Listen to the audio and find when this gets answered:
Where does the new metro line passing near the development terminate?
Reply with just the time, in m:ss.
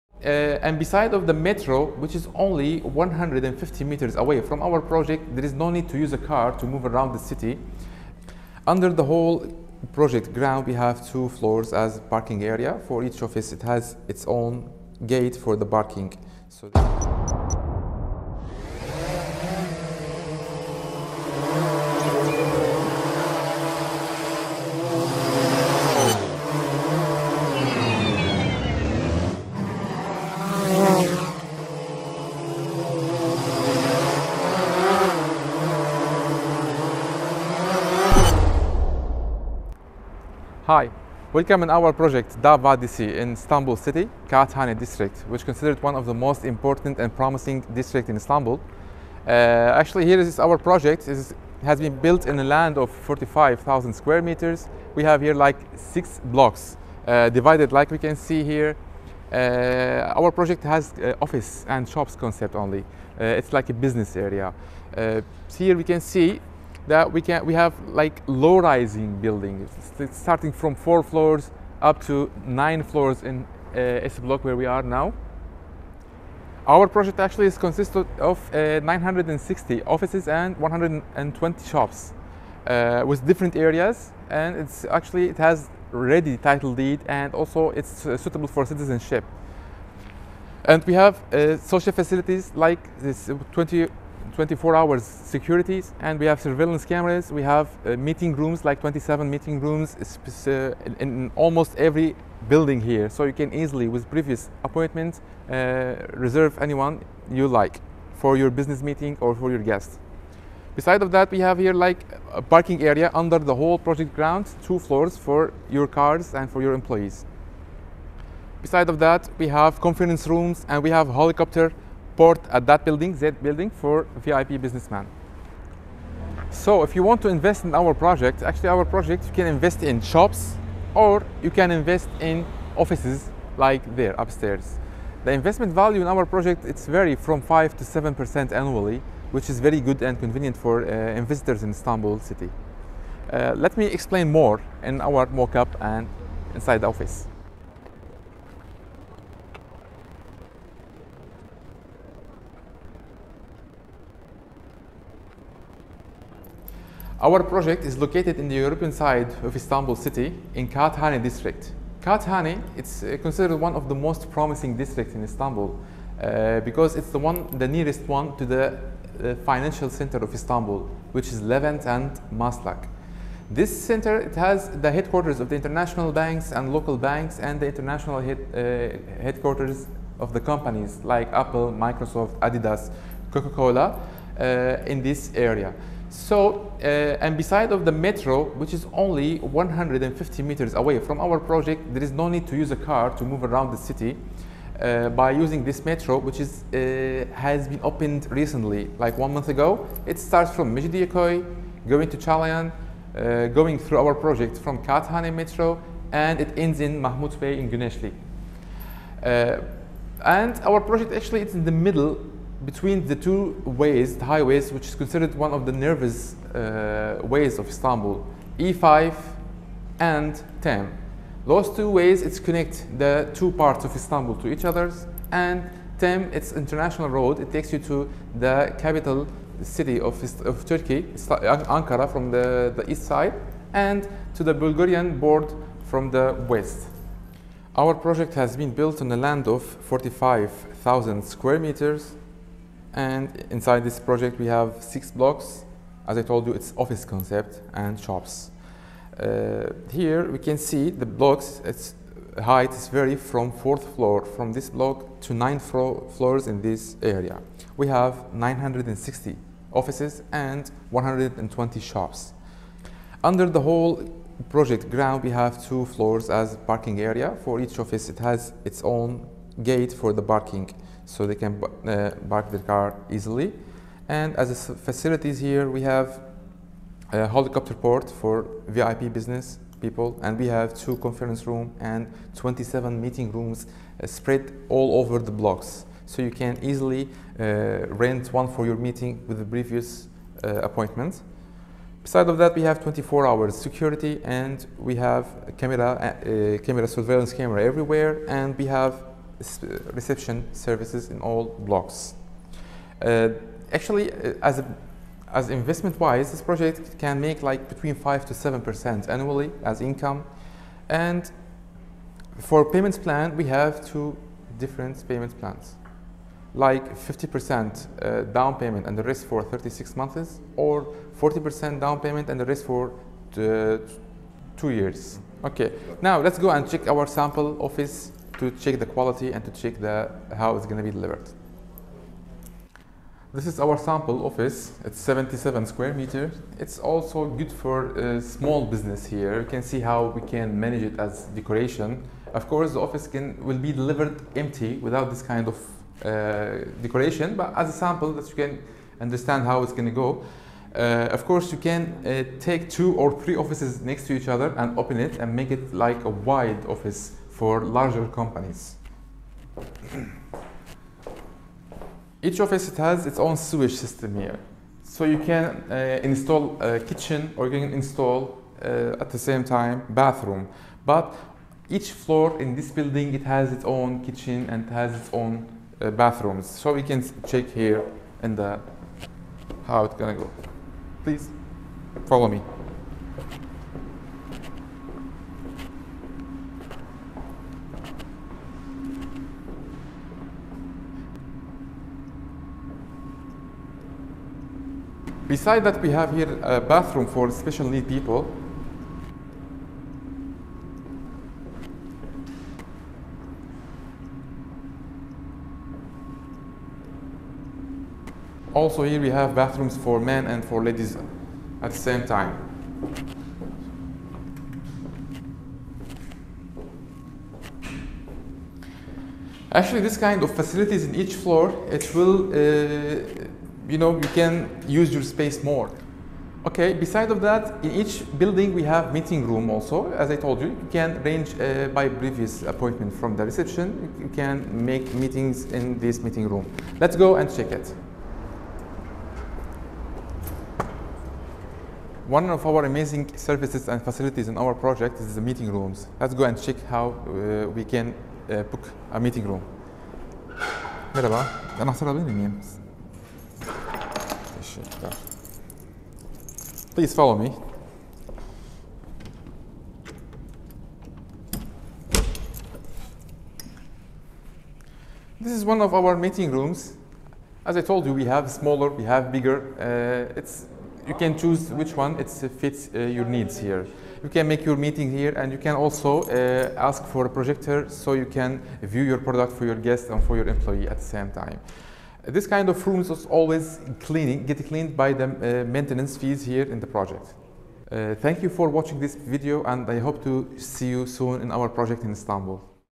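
3:26.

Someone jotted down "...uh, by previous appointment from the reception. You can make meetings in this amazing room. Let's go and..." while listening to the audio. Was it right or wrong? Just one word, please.
wrong.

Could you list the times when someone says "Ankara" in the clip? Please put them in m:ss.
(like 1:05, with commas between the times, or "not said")
3:51.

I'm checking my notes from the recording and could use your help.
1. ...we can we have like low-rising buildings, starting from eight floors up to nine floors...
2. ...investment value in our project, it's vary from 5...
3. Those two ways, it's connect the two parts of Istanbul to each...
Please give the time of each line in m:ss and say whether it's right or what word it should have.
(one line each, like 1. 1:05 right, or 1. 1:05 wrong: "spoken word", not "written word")
1. 1:07 wrong: "four", not "eight"
2. 2:15 right
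3. 3:41 right.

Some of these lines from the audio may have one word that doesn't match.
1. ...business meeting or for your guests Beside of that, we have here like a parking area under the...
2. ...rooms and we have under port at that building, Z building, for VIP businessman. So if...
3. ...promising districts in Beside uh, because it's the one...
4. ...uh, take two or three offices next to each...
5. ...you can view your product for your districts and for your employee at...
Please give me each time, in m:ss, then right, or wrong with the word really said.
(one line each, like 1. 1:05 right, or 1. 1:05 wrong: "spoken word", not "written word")
1. 1:48 right
2. 2:00 wrong: "helicopter", not "under"
3. 2:44 wrong: "Istanbul", not "Beside"
4. 5:52 right
5. 7:57 wrong: "guests", not "districts".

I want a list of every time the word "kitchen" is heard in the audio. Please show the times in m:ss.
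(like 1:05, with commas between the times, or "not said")
6:06, 6:14.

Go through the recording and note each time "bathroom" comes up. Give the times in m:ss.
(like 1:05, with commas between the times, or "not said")
6:09, 6:15, 6:36, 6:49.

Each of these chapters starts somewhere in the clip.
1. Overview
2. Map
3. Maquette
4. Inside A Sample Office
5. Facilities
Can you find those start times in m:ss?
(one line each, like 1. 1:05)
1. 0:40
2. 2:37
3. 3:57
4. 5:33
5. 6:32.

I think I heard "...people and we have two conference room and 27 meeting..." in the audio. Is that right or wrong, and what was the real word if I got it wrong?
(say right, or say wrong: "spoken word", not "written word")
right.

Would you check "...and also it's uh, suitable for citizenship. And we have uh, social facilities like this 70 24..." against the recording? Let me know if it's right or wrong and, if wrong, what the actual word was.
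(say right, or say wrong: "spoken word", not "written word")
wrong: "20", not "70".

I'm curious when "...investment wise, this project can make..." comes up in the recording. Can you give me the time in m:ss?
5:05.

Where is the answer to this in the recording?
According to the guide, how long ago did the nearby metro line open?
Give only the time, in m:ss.
3:19.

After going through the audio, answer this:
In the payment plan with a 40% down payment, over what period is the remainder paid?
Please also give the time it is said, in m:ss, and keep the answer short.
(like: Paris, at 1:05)
two years, at 5:24.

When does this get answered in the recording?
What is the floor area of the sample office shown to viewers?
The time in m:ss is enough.
5:34.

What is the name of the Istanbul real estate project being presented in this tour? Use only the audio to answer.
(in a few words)
Davadisi.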